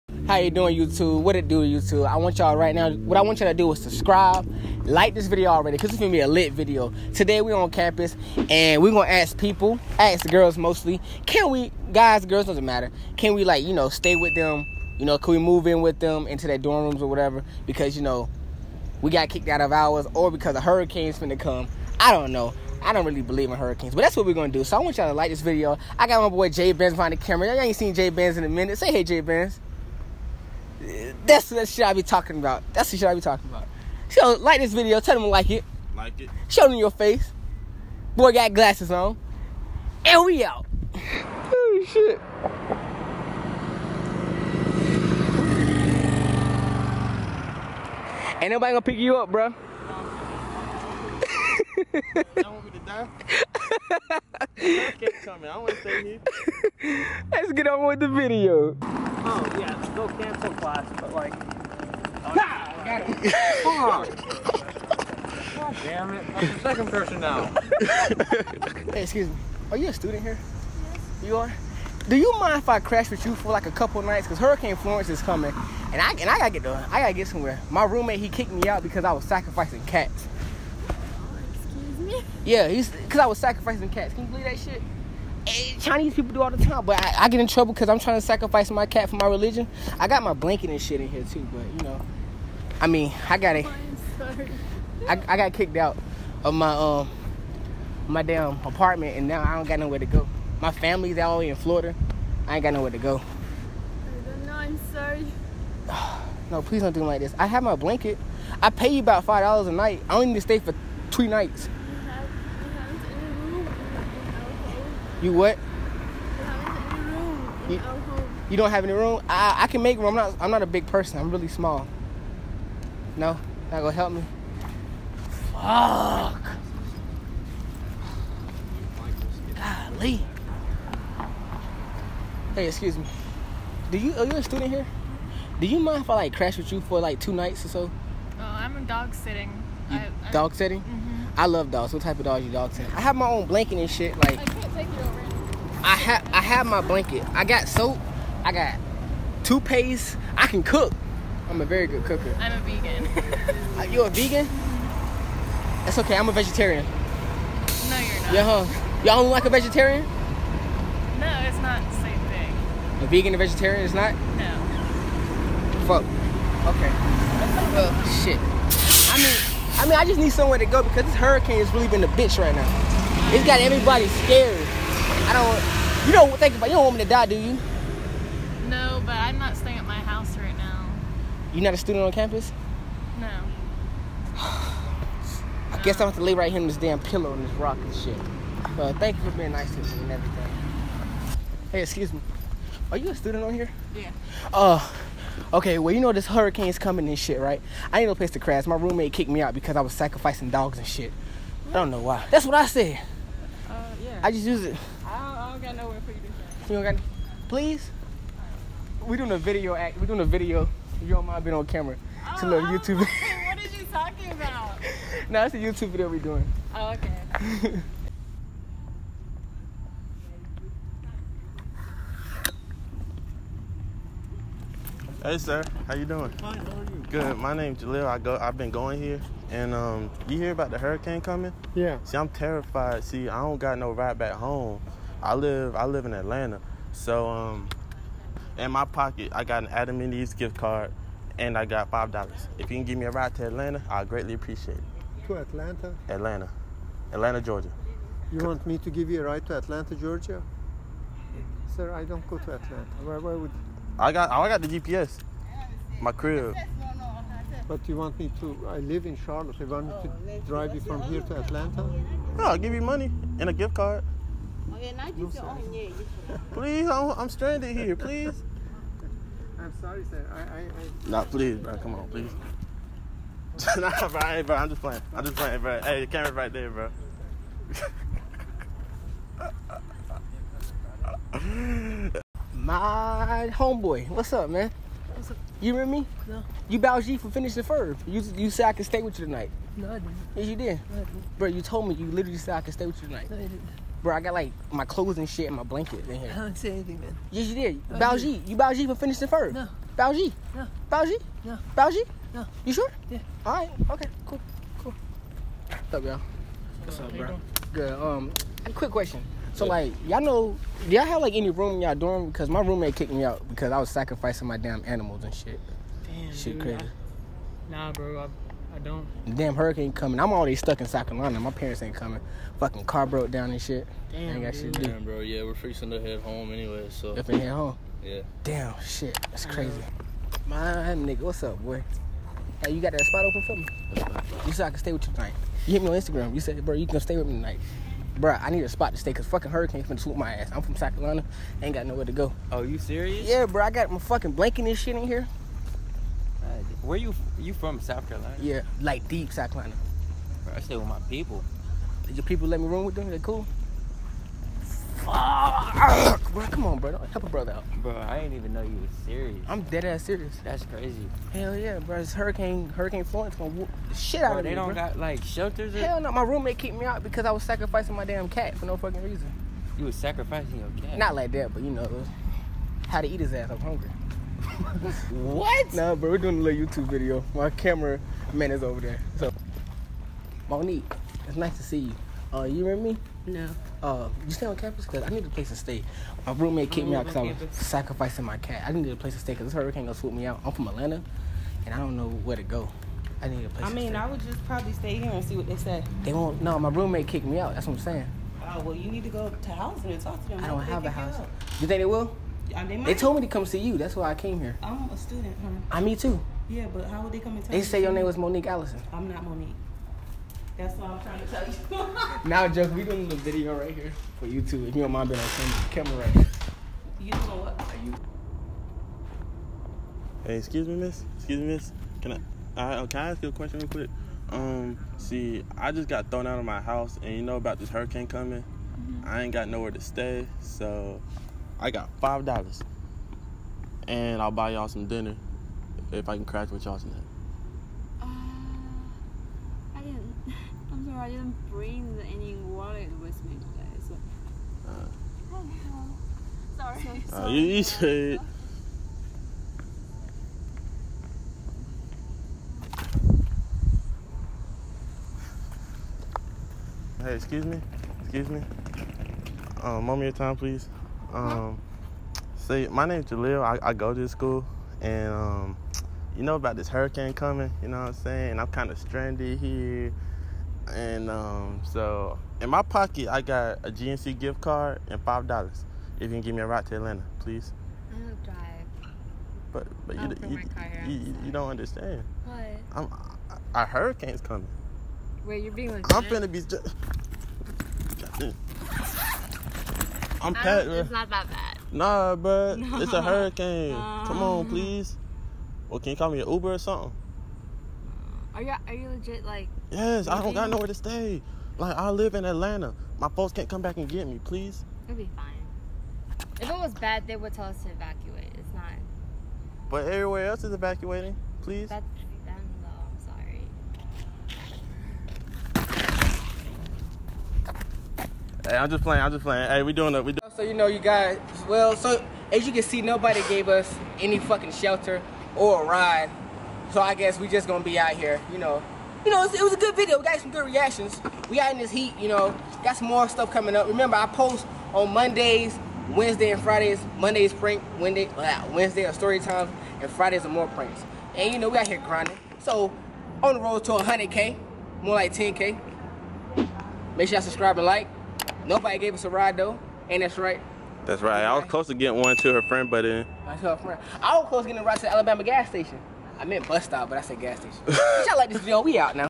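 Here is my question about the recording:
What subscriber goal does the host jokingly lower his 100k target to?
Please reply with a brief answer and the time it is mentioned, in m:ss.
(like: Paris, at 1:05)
10k, at 9:05.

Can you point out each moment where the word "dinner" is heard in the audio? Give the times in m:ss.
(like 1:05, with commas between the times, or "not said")
7:14.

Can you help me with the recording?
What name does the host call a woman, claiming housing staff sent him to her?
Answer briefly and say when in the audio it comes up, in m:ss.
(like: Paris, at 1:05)
Monique Allison, at 6:48.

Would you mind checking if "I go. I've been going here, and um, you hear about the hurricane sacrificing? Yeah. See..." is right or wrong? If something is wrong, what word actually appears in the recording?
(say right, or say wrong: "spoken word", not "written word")
wrong: "coming", not "sacrificing".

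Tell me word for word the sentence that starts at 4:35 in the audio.
Hey, the camera's right there, bro.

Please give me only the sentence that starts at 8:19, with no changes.
Yes, I don't got nowhere to stay.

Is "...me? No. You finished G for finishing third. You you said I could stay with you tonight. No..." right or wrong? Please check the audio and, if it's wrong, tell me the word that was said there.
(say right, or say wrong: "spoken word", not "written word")
wrong: "bowed", not "finished".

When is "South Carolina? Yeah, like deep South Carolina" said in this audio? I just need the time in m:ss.
5:47.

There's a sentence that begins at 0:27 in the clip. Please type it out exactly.
Y'all ain't seen Jay Benz in a minute.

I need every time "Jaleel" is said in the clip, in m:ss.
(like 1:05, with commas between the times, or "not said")
3:47, 7:43.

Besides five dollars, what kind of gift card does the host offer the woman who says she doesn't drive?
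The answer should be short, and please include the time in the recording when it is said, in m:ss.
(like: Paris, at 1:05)
GNC, at 7:53.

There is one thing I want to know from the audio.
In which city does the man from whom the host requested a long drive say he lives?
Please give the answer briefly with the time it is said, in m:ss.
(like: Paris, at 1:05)
Charlotte, at 4:19.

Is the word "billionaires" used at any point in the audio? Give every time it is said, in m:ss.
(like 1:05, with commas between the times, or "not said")
not said.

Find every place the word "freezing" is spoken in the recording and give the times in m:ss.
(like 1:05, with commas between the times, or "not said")
5:25.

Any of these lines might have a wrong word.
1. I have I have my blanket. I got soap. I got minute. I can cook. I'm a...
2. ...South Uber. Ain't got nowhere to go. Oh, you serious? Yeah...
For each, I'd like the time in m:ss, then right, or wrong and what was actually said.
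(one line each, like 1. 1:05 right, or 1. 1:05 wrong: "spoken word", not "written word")
1. 2:25 wrong: "toothpaste", not "minute"
2. 5:40 wrong: "Carolina", not "Uber".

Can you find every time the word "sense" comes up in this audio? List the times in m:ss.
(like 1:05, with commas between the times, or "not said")
not said.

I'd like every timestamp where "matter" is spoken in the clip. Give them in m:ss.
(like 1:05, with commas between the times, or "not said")
0:12.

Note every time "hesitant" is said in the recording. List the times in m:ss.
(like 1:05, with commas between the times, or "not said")
not said.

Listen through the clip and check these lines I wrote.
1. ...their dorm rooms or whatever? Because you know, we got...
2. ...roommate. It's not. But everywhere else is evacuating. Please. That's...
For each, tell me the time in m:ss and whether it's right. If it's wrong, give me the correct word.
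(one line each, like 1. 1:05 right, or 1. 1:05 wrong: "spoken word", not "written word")
1. 0:16 right
2. 8:27 wrong: "evacuate", not "roommate".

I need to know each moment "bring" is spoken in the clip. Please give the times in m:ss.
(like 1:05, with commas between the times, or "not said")
7:21.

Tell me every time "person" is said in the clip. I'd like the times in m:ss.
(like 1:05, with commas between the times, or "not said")
1:06, 2:00.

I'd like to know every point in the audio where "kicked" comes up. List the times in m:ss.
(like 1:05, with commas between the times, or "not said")
0:19, 1:18, 1:35, 3:19, 5:12, 6:06, 6:26, 6:37.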